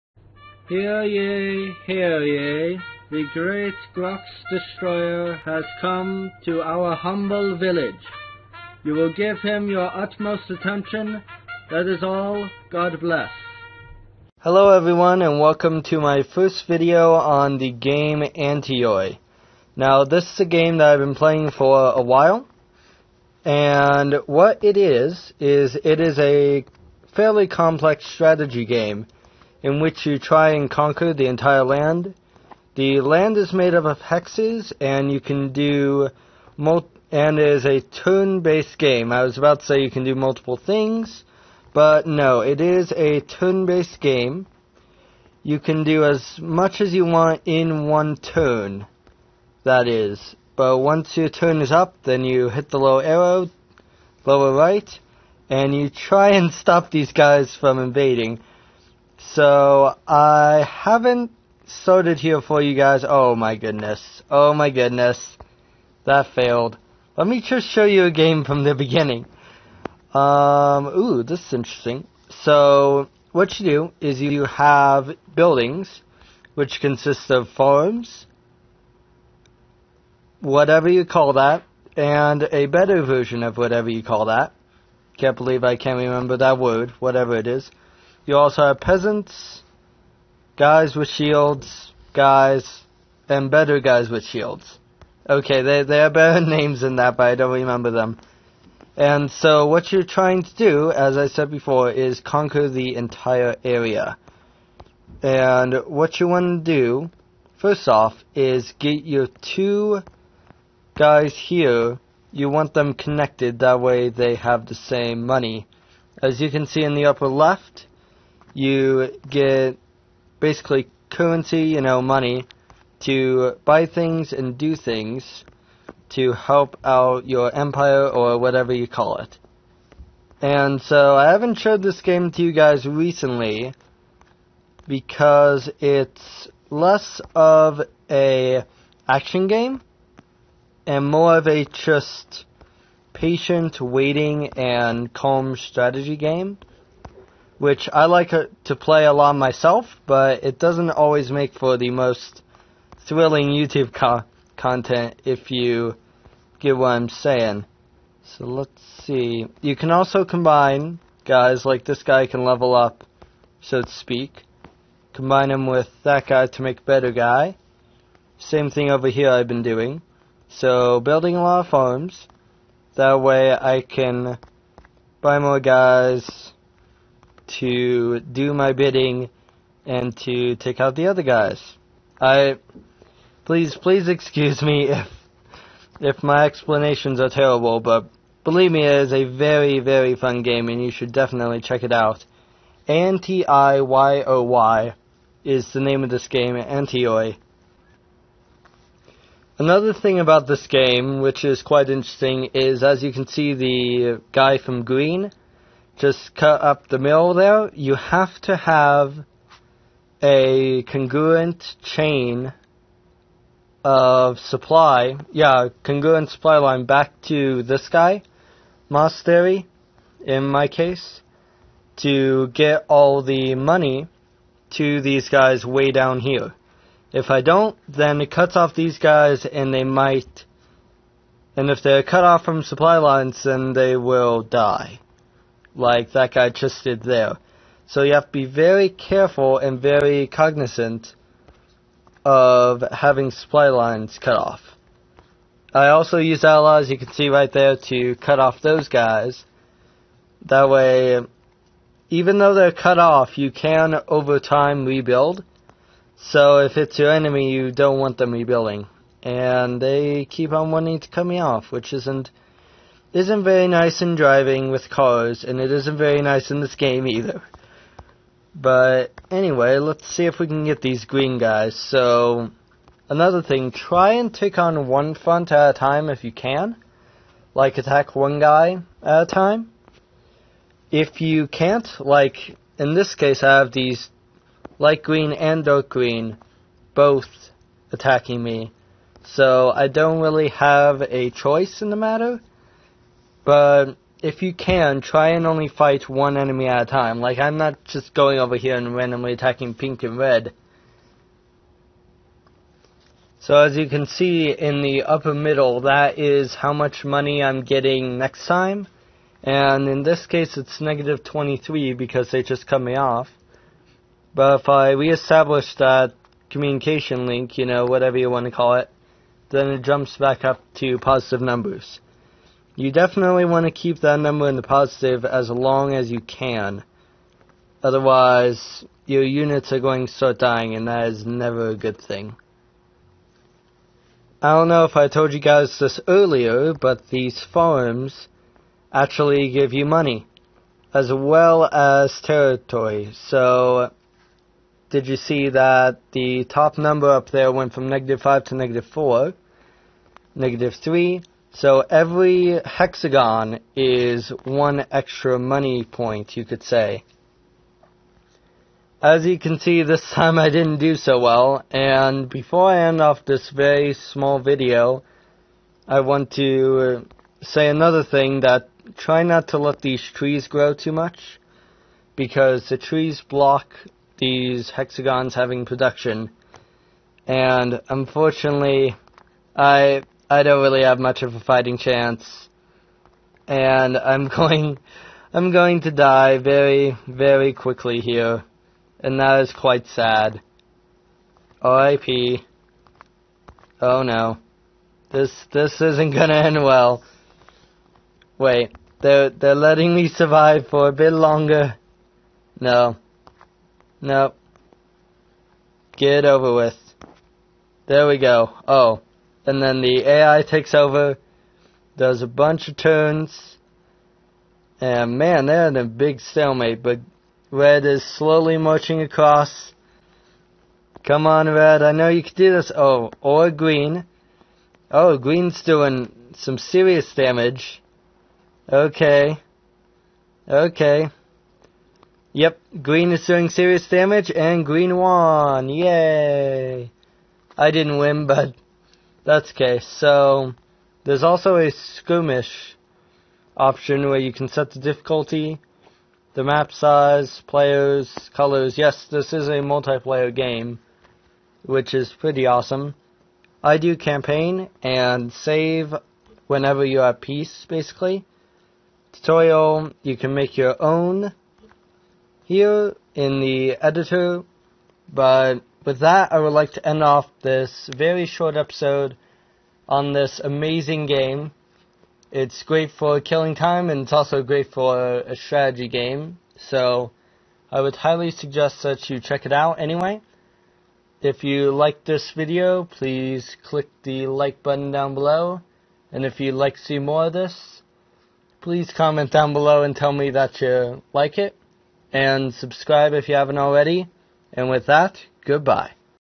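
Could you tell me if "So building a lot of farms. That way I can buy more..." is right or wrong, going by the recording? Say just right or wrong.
right.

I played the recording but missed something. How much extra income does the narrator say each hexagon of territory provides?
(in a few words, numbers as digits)
1.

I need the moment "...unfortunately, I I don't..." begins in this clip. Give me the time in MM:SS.
06:17.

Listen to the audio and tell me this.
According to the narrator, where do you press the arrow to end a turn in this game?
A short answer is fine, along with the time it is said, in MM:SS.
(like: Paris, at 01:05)
lower right, at 00:54.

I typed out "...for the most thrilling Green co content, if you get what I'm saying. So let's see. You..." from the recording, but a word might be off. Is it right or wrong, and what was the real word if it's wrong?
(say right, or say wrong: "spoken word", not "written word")
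wrong: "YouTube", not "Green".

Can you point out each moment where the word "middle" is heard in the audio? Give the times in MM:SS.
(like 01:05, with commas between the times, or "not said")
03:26, 05:05.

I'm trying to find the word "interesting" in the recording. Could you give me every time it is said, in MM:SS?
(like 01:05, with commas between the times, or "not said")
01:11, 03:21.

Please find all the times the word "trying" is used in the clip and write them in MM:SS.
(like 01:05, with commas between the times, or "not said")
01:40.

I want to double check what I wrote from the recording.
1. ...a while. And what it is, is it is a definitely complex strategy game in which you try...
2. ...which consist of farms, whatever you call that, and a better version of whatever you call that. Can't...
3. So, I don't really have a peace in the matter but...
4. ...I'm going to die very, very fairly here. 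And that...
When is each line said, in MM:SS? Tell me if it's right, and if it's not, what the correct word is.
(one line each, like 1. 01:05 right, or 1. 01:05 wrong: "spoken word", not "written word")
1. 00:21 wrong: "fairly", not "definitely"
2. 01:16 right
3. 04:49 wrong: "choice", not "peace"
4. 06:25 wrong: "quickly", not "fairly".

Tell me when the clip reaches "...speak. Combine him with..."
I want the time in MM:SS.
02:43.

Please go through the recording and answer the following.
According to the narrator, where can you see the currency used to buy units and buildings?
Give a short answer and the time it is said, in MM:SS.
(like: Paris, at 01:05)
upper left, at 01:57.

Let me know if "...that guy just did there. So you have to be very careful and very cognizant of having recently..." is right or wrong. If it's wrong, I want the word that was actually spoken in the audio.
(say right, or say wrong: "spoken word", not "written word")
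wrong: "supply", not "recently".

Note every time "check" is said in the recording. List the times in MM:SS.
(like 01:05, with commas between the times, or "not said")
03:11, 07:59.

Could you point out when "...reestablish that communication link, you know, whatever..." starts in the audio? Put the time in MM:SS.
05:14.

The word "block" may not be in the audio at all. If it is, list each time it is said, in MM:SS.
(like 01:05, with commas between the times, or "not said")
06:13.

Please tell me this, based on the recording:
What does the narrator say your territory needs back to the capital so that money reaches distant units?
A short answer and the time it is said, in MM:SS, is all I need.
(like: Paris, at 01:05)
supply line, at 03:35.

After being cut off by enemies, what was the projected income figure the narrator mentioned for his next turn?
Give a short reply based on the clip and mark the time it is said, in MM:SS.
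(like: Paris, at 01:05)
-23, at 05:10.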